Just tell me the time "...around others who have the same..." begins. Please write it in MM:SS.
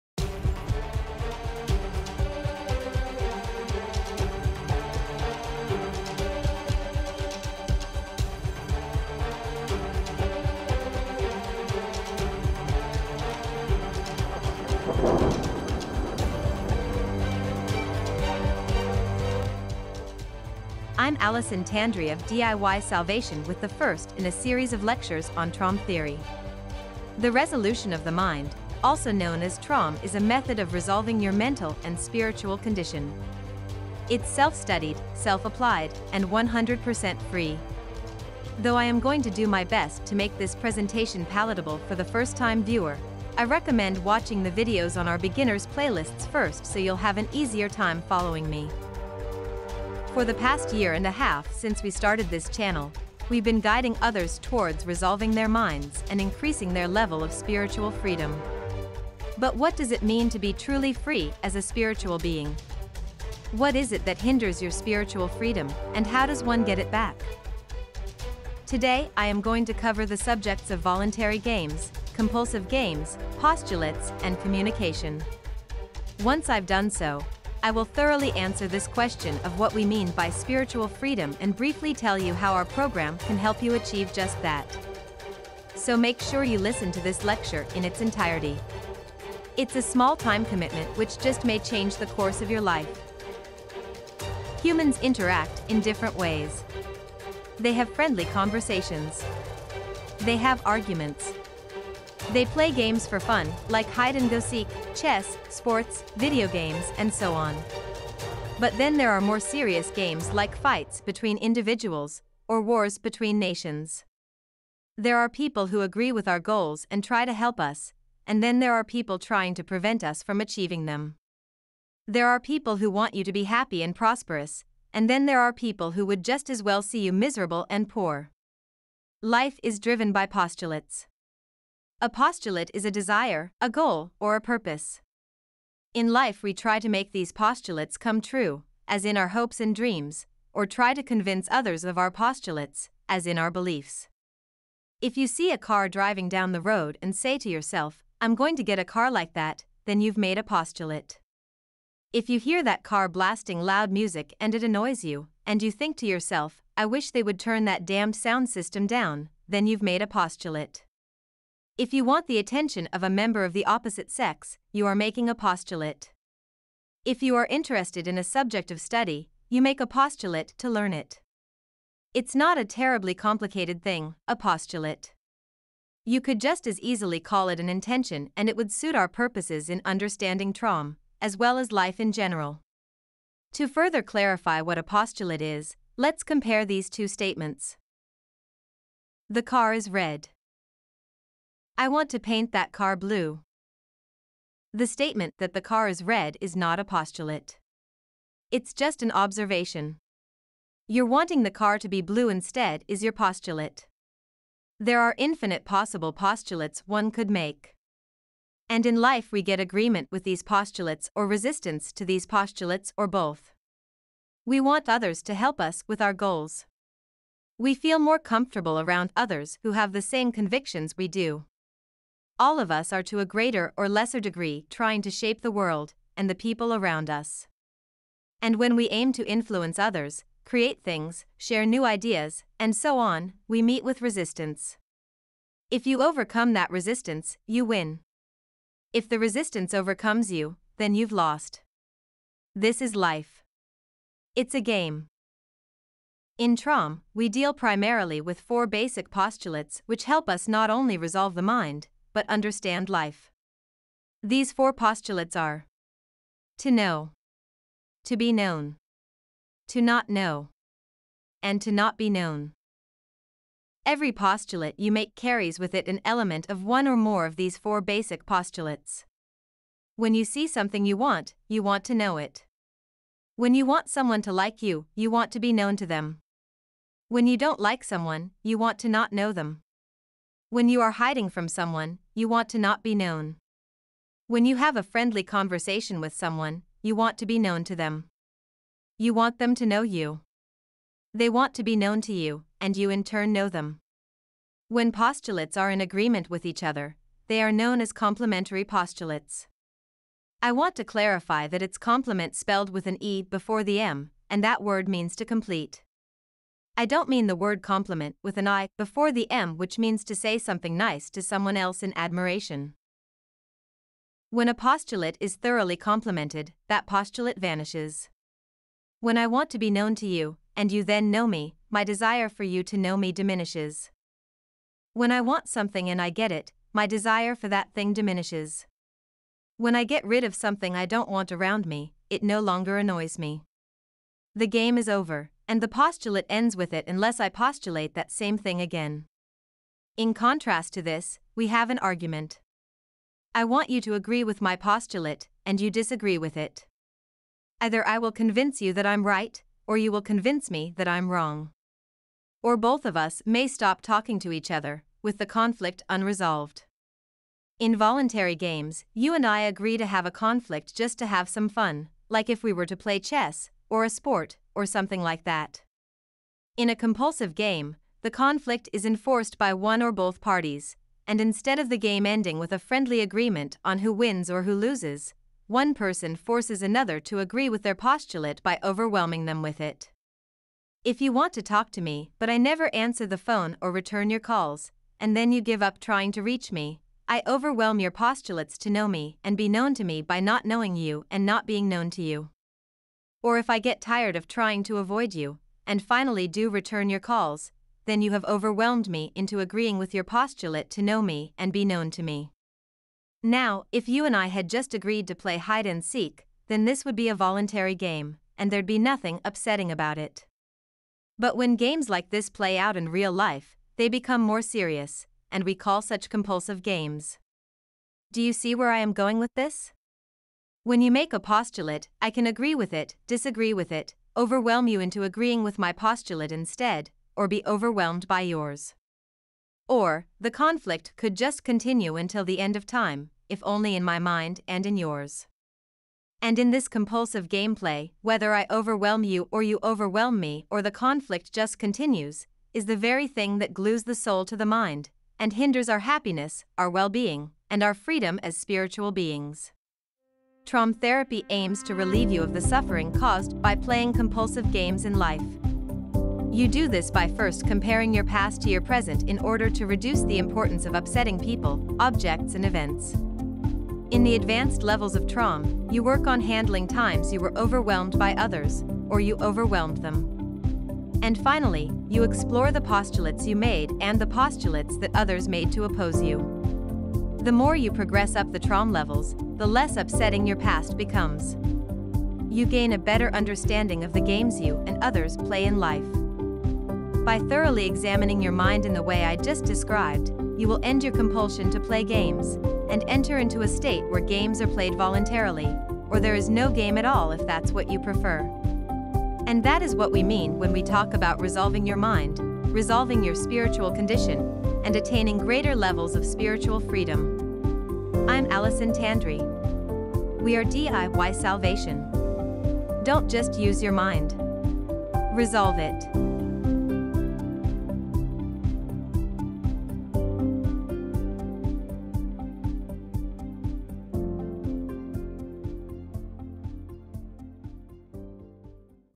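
03:38.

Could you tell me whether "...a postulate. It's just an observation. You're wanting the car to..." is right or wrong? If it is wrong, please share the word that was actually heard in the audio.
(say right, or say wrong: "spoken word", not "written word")
right.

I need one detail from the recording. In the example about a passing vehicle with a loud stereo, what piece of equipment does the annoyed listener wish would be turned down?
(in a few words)
sound system.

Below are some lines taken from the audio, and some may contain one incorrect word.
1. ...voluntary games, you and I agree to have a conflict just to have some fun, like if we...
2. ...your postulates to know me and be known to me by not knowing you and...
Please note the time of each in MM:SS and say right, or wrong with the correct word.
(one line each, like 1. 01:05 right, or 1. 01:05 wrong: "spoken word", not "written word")
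1. 05:57 right
2. 06:27 right.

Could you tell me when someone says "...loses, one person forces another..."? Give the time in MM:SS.
06:14.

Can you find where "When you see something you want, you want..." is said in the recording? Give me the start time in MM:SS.
04:29.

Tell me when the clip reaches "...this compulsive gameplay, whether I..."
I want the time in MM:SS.
07:16.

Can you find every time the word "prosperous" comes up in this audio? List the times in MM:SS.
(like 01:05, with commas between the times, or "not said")
02:03.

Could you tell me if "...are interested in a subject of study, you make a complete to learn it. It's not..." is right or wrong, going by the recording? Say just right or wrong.
wrong.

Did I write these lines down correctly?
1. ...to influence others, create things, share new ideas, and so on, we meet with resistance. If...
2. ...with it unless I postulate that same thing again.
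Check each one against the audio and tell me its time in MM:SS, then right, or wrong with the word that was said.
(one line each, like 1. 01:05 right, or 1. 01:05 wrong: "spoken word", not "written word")
1. 03:49 right
2. 05:36 right.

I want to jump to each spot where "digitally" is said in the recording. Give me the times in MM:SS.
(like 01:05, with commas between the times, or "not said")
not said.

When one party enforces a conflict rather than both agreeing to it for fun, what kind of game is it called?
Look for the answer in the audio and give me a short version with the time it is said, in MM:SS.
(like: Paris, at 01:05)
compulsive game, at 06:06.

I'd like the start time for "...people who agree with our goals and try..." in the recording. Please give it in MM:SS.
01:55.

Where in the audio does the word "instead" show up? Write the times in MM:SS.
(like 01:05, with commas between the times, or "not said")
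03:22, 06:11, 07:06.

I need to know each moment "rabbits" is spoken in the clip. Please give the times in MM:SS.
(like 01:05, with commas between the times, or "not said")
not said.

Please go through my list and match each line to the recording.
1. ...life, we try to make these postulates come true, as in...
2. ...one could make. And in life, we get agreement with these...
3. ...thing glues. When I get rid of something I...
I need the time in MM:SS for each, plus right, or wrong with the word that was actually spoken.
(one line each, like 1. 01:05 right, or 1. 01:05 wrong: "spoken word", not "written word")
1. 02:16 right
2. 03:26 right
3. 05:27 wrong: "diminishes", not "glues".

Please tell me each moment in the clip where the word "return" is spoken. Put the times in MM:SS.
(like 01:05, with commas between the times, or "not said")
06:23, 06:36.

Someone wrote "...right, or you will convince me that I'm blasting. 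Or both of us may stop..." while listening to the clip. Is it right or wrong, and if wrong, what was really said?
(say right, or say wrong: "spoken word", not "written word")
wrong: "wrong", not "blasting".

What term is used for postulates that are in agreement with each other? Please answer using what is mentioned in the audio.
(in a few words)
complementary postulates.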